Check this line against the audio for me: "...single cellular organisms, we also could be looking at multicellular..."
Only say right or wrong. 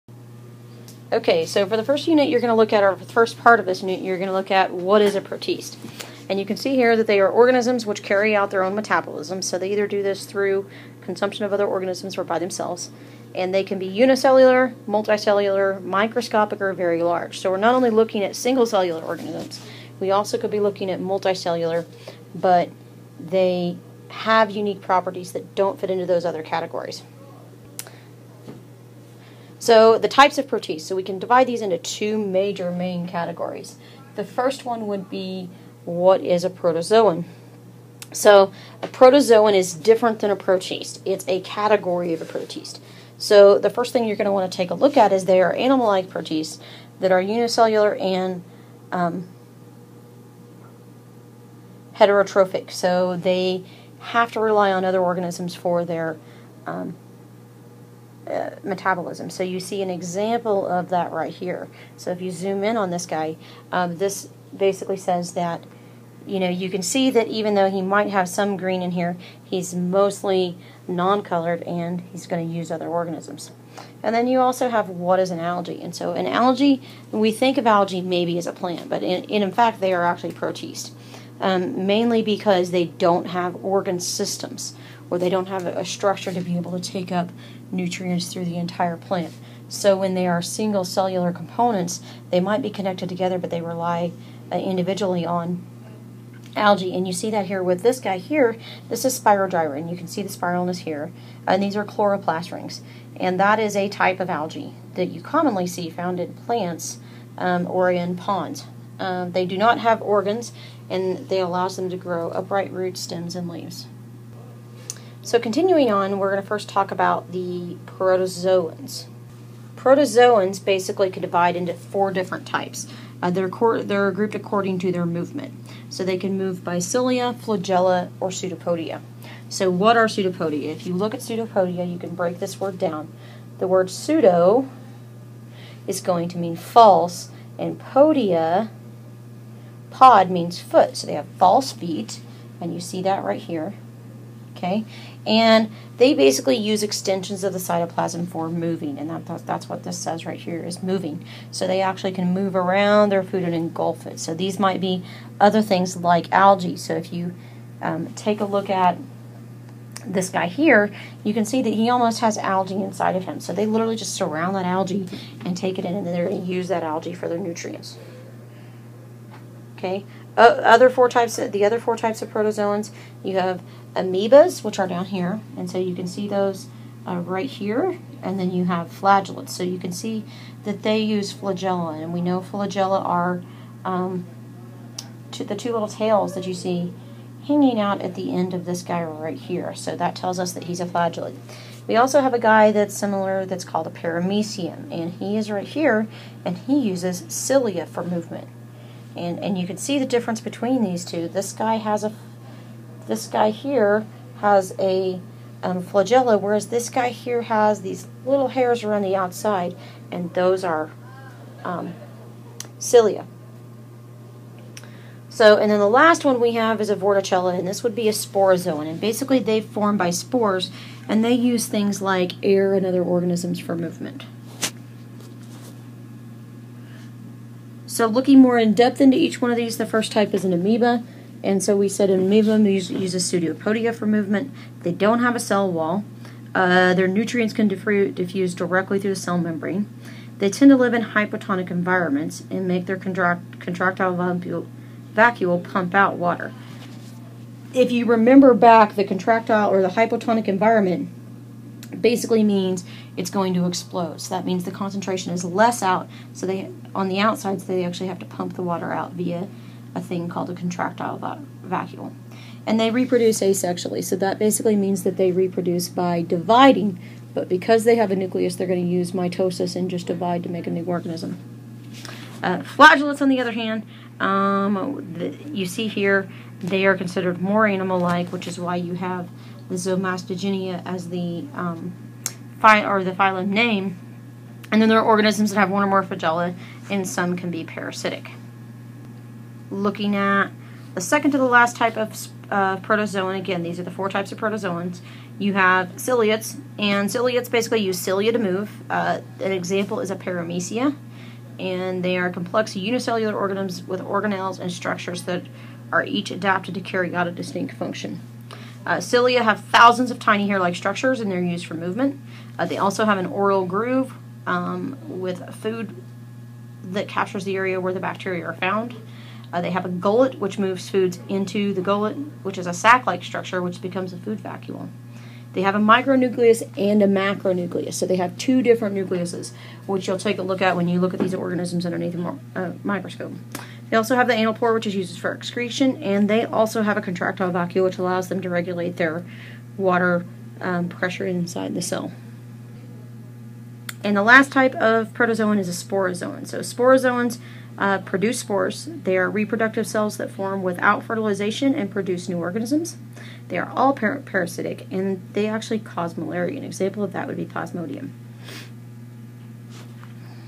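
right.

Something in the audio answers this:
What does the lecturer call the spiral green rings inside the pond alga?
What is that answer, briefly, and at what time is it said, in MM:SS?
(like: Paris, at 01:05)
chloroplast rings, at 01:41.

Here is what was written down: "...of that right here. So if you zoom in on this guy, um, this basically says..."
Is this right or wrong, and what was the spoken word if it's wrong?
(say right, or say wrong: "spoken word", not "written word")
right.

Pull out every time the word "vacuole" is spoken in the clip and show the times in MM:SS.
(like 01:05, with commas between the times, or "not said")
04:05, 04:21, 05:24, 05:37.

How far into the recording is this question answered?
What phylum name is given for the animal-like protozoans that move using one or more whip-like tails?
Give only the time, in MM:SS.
04:39.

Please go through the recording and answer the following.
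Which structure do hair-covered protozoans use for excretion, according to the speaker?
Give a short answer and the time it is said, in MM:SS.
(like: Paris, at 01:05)
anal pore, at 05:34.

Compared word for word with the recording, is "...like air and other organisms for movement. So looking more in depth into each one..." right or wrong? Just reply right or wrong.
right.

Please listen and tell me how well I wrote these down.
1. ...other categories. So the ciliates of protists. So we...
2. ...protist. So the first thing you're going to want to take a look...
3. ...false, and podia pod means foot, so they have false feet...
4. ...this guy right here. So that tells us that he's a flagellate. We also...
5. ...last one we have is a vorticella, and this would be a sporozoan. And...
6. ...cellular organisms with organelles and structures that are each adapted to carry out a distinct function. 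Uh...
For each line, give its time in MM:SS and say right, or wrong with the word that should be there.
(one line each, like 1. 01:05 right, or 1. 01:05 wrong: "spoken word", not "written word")
1. 00:26 wrong: "types", not "ciliates"
2. 00:42 right
3. 02:16 right
4. 03:08 right
5. 03:35 right
6. 05:02 wrong: "unicellular", not "cellular".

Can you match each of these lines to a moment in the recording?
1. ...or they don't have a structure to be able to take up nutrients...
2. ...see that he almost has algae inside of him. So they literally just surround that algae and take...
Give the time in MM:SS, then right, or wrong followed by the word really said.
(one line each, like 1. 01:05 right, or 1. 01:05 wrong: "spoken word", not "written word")
1. 01:25 right
2. 02:41 right.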